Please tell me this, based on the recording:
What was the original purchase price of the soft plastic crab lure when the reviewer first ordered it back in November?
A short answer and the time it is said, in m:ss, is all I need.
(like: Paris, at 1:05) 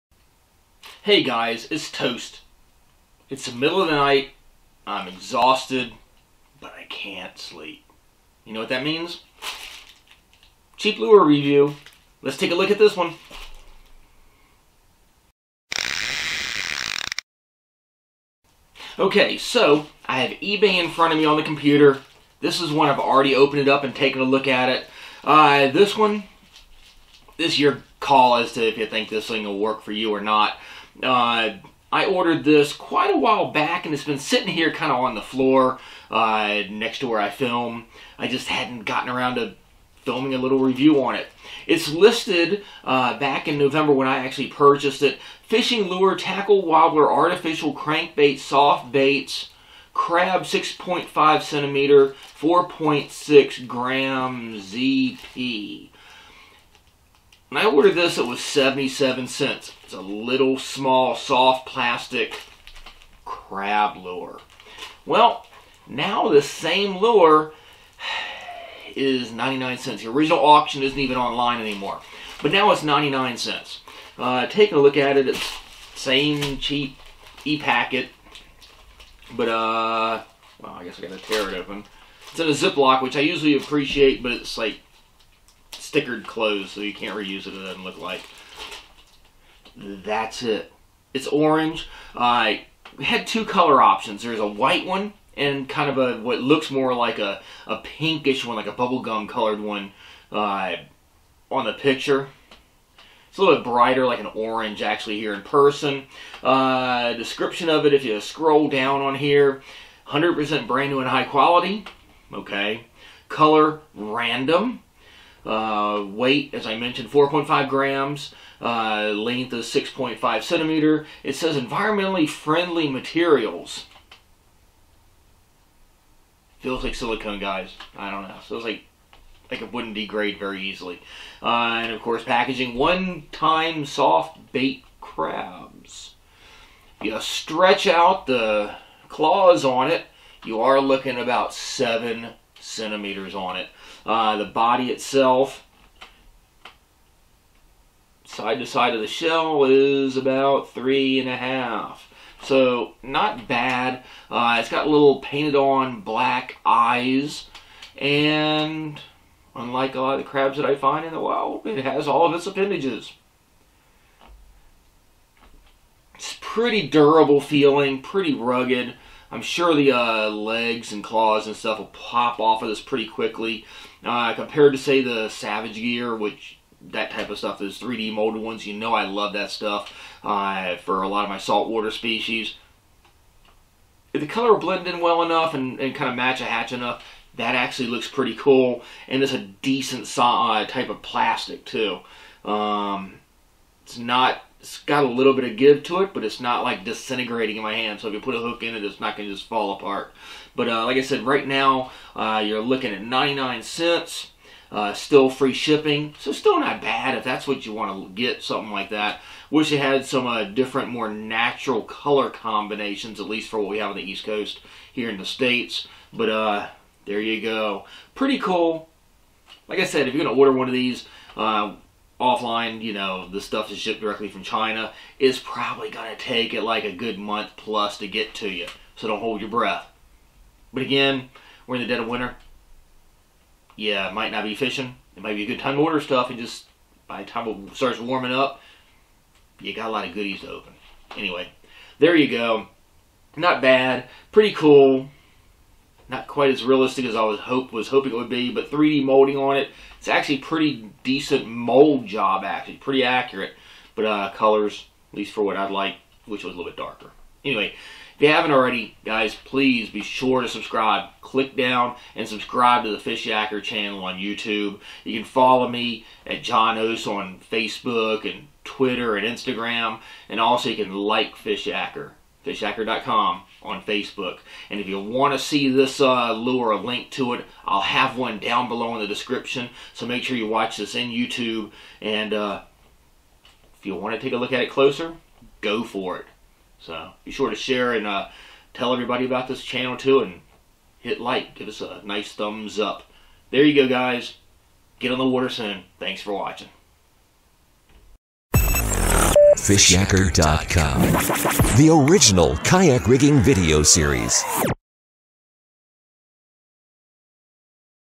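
77 cents, at 0:58.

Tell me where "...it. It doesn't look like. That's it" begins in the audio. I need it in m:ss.
1:27.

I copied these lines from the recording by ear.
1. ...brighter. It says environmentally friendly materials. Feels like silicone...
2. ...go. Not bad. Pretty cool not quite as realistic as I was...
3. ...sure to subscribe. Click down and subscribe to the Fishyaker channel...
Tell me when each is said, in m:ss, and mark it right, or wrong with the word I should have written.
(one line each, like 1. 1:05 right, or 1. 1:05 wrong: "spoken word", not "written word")
1. 2:00 wrong: "centimeter", not "brighter"
2. 4:02 right
3. 4:20 right.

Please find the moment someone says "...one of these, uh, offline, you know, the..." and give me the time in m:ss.
3:40.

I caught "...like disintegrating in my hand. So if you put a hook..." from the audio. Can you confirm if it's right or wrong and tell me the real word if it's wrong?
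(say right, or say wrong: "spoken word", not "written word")
right.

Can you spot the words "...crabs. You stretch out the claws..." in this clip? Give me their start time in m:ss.
2:15.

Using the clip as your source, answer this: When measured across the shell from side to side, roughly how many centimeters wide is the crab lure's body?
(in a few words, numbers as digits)
3.5.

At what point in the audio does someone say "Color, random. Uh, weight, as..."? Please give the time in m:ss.
1:53.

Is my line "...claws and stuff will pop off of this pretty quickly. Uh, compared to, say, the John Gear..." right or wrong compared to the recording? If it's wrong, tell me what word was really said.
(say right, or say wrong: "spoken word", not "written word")
wrong: "Savage", not "John".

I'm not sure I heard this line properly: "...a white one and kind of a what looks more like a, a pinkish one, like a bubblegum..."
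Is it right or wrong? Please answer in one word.
right.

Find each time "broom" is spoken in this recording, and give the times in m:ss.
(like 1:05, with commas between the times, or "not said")
not said.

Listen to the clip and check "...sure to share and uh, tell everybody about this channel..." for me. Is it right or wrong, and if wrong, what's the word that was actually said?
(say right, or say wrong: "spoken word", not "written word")
right.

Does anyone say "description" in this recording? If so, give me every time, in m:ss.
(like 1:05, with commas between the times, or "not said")
1:47, 4:39.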